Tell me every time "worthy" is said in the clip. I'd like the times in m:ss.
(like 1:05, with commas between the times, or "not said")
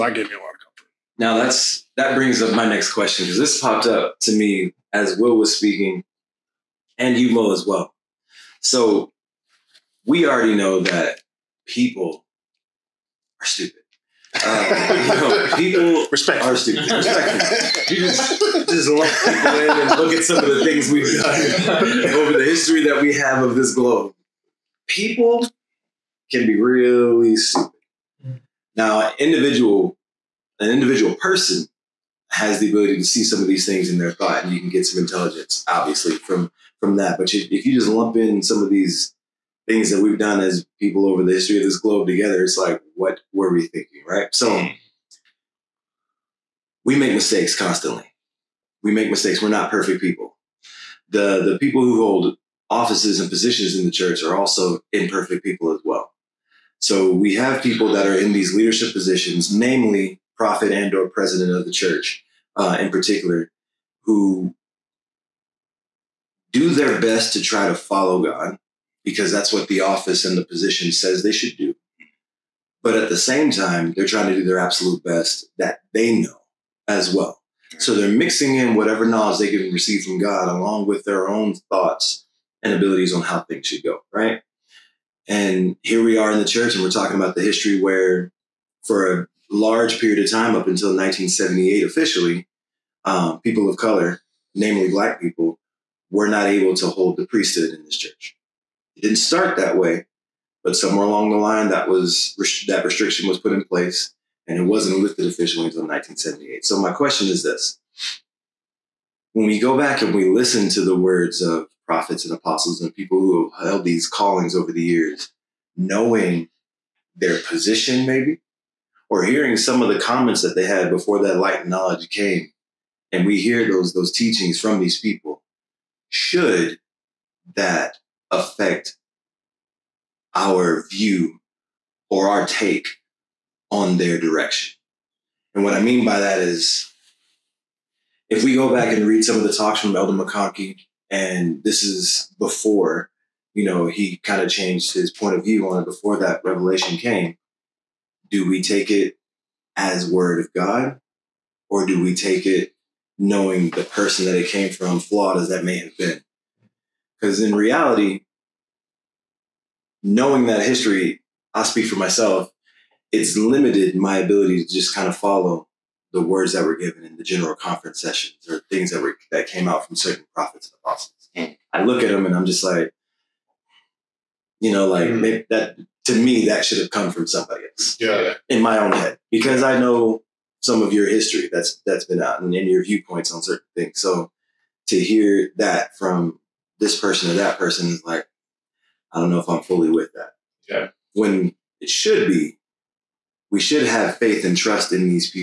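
not said.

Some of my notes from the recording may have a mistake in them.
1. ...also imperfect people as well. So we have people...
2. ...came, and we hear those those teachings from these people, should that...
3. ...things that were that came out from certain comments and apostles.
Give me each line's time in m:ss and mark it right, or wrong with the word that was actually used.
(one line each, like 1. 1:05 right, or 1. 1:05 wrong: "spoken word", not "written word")
1. 0:54 right
2. 2:02 right
3. 2:48 wrong: "prophets", not "comments".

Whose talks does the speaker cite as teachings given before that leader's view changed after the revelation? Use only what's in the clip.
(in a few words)
Elder McConkie.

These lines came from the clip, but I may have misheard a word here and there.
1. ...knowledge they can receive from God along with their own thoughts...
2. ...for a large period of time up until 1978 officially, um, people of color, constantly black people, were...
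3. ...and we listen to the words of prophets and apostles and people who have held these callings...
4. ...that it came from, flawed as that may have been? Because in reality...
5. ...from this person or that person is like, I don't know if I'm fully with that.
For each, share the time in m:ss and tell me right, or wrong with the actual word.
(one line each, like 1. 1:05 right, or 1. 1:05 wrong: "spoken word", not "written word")
1. 1:19 right
2. 1:28 wrong: "namely", not "constantly"
3. 1:50 right
4. 2:34 right
5. 3:05 right.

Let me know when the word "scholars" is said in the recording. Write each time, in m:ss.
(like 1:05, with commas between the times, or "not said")
not said.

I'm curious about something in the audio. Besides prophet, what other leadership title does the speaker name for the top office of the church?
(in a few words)
president of the church.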